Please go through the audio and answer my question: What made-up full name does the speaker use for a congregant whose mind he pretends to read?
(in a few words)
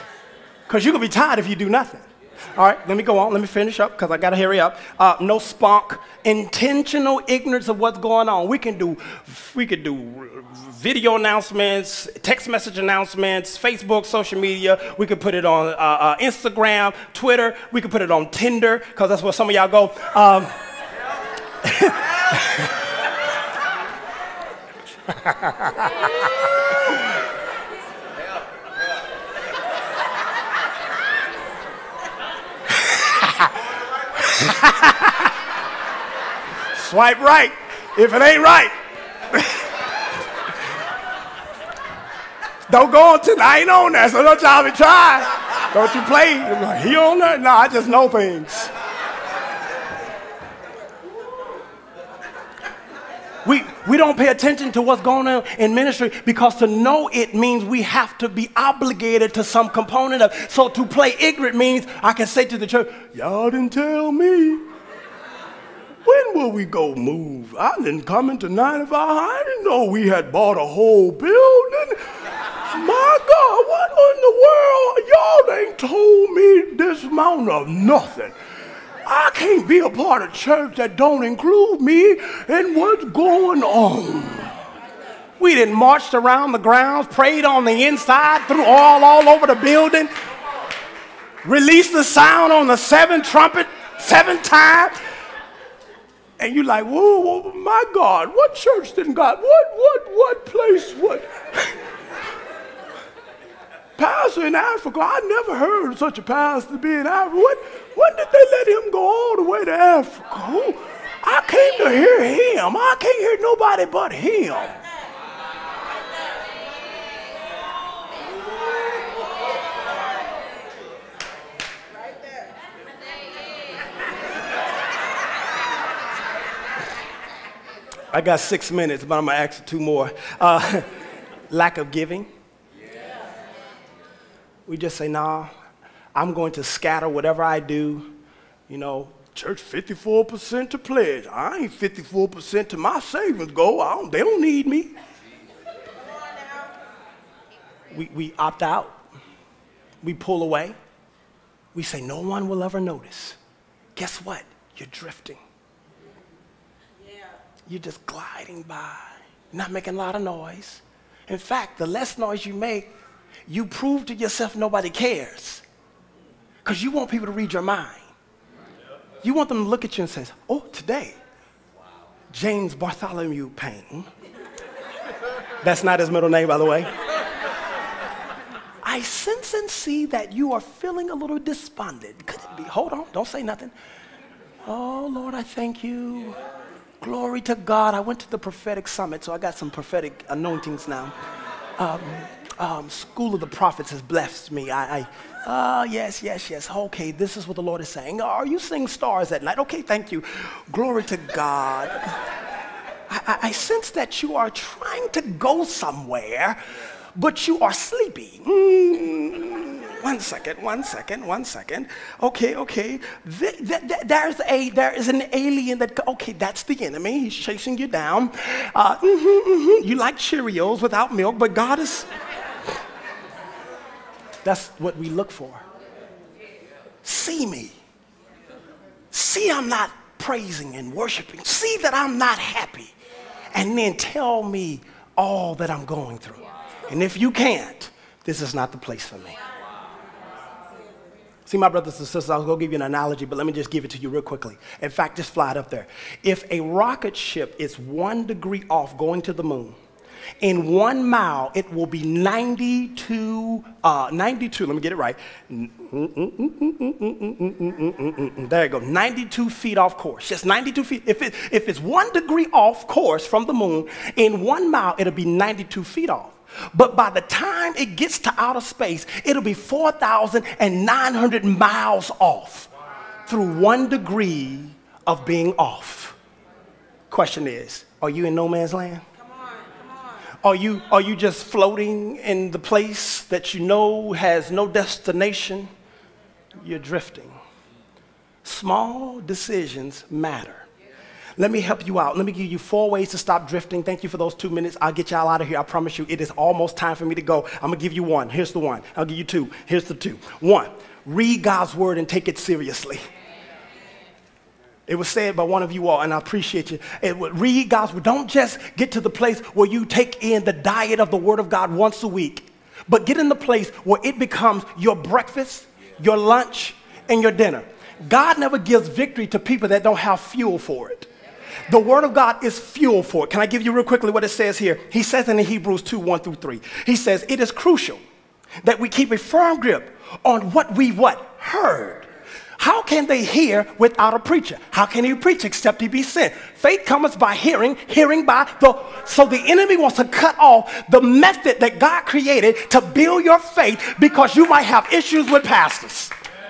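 James Bartholomew Payne.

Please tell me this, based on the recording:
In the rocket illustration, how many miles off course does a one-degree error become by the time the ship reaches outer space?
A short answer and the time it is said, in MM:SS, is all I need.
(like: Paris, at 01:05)
4,900 miles, at 04:29.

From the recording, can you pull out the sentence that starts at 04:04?
In fact, just fly it up there.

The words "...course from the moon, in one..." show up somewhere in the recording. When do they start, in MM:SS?
04:22.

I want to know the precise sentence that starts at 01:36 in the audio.
And you're like, whoa, whoa my God, what church didn't God, what, what, what place, what?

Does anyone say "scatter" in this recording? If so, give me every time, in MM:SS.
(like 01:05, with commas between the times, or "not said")
02:16.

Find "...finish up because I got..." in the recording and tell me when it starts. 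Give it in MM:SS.
00:03.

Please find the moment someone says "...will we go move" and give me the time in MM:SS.
01:06.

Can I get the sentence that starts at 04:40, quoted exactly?
Are you, are you just floating in the place that you know has no destination?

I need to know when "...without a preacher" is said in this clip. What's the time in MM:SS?
05:33.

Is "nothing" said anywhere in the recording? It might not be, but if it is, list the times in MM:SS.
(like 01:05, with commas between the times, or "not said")
00:01, 01:17, 03:03.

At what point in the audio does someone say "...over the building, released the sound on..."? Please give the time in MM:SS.
01:29.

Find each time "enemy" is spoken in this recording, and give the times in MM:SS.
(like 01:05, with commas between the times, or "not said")
03:36, 05:39.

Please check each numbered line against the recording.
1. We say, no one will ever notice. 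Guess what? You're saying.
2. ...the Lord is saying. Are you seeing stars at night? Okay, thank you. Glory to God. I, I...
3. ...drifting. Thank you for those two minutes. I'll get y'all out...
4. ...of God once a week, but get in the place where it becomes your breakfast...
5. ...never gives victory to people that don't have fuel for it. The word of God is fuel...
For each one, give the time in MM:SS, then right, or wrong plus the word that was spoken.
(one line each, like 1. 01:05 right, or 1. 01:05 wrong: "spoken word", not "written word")
1. 02:31 wrong: "drifting", not "saying"
2. 03:17 right
3. 04:53 right
4. 05:11 right
5. 05:18 right.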